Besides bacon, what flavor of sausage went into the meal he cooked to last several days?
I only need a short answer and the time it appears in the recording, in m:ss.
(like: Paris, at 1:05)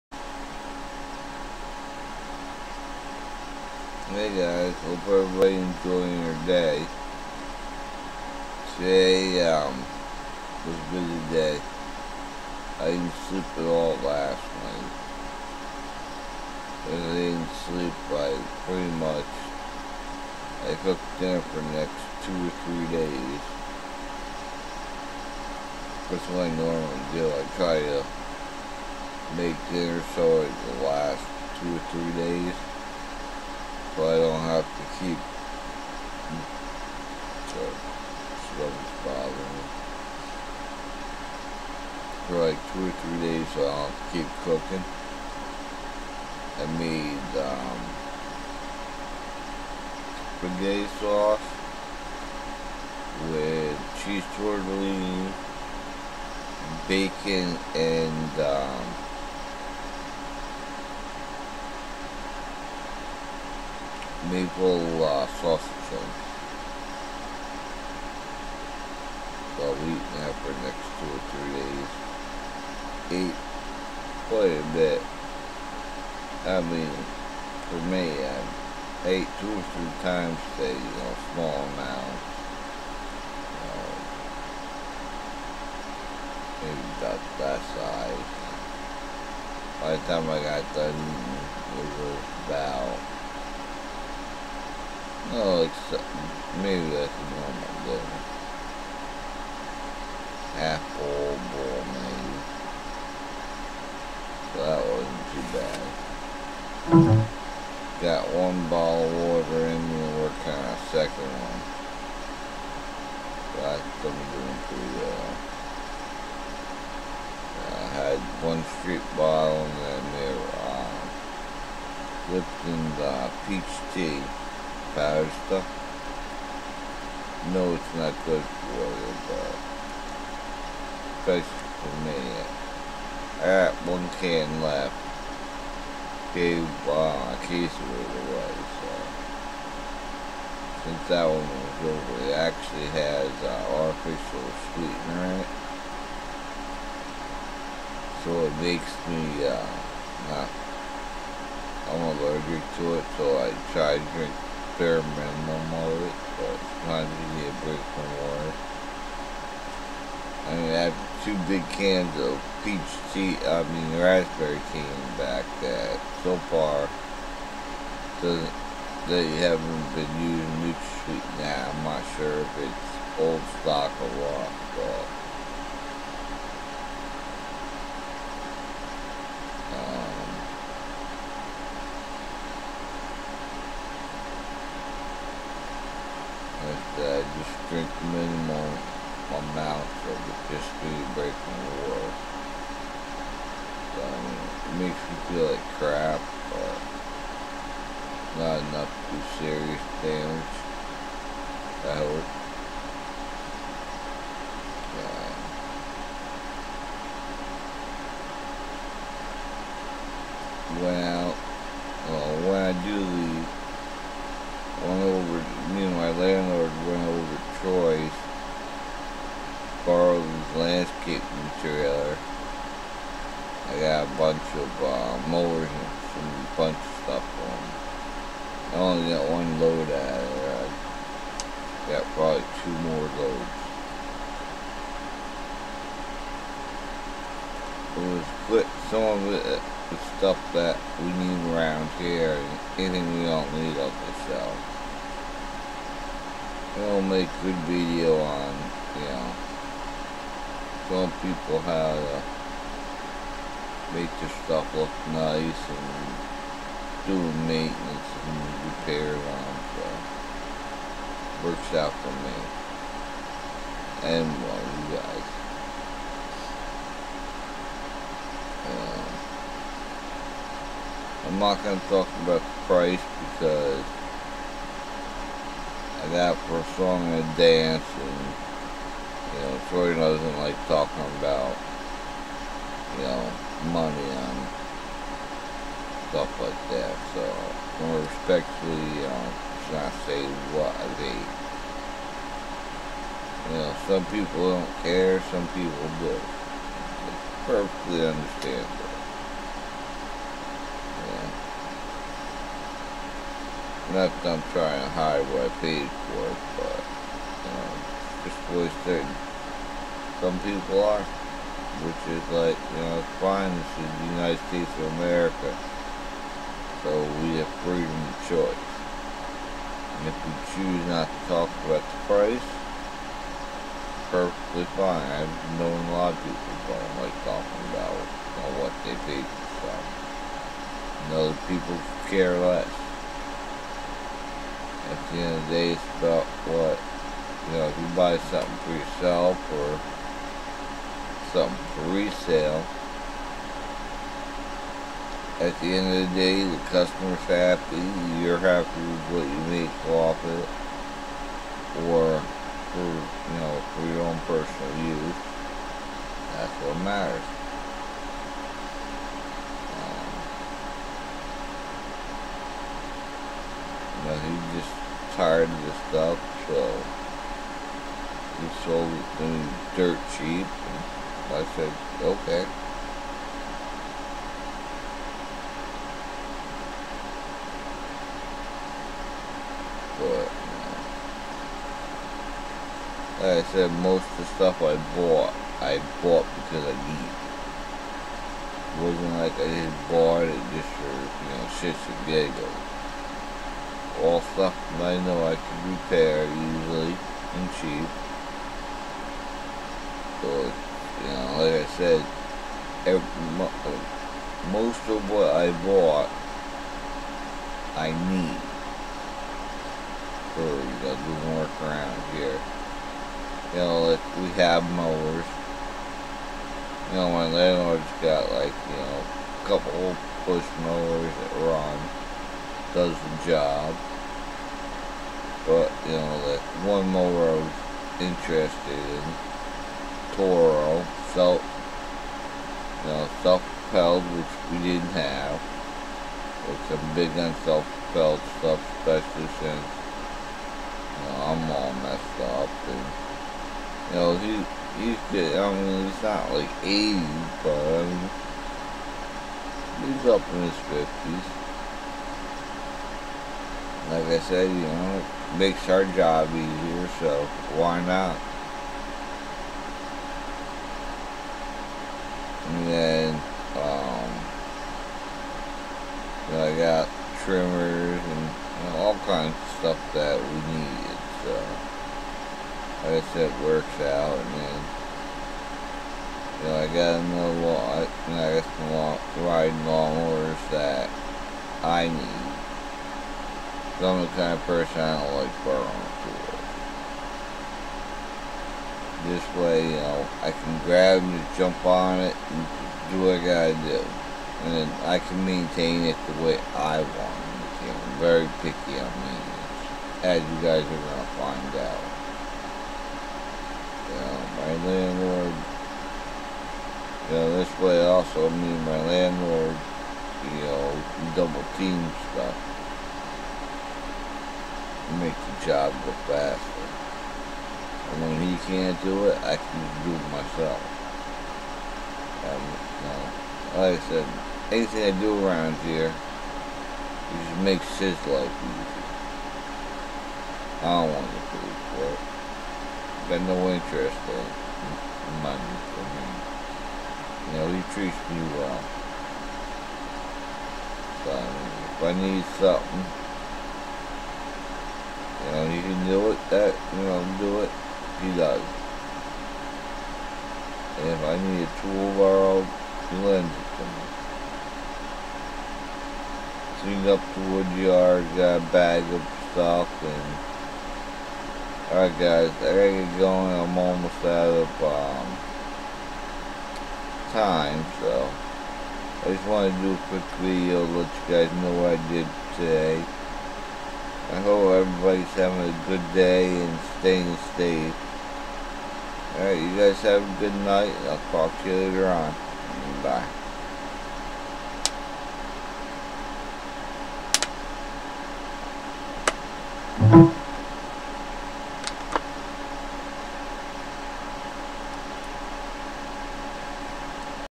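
maple, at 1:04.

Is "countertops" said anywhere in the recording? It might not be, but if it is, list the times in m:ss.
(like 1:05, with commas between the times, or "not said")
not said.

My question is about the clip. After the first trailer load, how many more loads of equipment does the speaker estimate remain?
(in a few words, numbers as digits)
2.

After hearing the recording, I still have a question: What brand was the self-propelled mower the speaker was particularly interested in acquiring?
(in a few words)
Toro.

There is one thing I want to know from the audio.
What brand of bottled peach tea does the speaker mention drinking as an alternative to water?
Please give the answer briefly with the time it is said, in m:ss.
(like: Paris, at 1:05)
Lipton, at 2:03.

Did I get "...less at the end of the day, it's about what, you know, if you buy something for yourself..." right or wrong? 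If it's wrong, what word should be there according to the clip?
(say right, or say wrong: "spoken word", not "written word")
right.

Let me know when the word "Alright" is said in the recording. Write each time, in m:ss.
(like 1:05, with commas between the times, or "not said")
9:21, 9:39.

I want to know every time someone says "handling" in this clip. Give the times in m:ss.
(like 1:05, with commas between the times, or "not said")
not said.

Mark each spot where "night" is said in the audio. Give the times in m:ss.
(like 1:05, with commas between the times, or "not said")
0:14, 9:40.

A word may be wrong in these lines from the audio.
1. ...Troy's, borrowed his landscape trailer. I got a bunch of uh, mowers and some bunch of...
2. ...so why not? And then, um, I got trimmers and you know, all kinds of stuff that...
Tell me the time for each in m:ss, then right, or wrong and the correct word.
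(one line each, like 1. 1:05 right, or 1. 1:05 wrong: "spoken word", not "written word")
1. 3:37 right
2. 7:36 right.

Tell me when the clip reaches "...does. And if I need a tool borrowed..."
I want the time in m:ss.
9:08.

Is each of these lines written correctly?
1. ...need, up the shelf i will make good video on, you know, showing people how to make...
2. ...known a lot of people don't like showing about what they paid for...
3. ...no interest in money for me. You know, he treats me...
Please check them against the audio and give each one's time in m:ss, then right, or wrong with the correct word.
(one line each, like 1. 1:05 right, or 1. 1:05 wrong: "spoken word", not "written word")
1. 4:03 right
2. 5:25 wrong: "talking", not "showing"
3. 8:53 right.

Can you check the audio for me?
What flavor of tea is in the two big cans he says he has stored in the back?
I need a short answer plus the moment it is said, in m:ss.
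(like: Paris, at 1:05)
raspberry, at 2:44.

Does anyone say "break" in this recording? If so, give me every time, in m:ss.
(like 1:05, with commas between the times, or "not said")
2:37, 3:11.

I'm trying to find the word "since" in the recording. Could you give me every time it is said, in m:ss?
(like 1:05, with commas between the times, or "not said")
2:20, 7:19.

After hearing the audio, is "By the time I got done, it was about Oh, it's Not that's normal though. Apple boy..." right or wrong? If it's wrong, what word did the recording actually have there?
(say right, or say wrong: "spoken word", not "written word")
wrong: "Maybe", not "Not".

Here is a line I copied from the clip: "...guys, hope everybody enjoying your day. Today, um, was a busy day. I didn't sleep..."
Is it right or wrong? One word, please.
right.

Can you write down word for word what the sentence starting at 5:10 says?
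Some people are, which is like, you know, it's fine.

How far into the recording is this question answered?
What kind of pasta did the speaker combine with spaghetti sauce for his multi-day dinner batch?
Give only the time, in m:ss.
0:54.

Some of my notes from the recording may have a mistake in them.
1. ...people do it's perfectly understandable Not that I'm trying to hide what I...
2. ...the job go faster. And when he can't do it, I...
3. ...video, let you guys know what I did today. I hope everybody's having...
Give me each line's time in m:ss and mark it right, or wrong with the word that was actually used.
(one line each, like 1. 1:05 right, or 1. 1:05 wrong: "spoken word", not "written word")
1. 4:55 right
2. 8:35 right
3. 9:30 right.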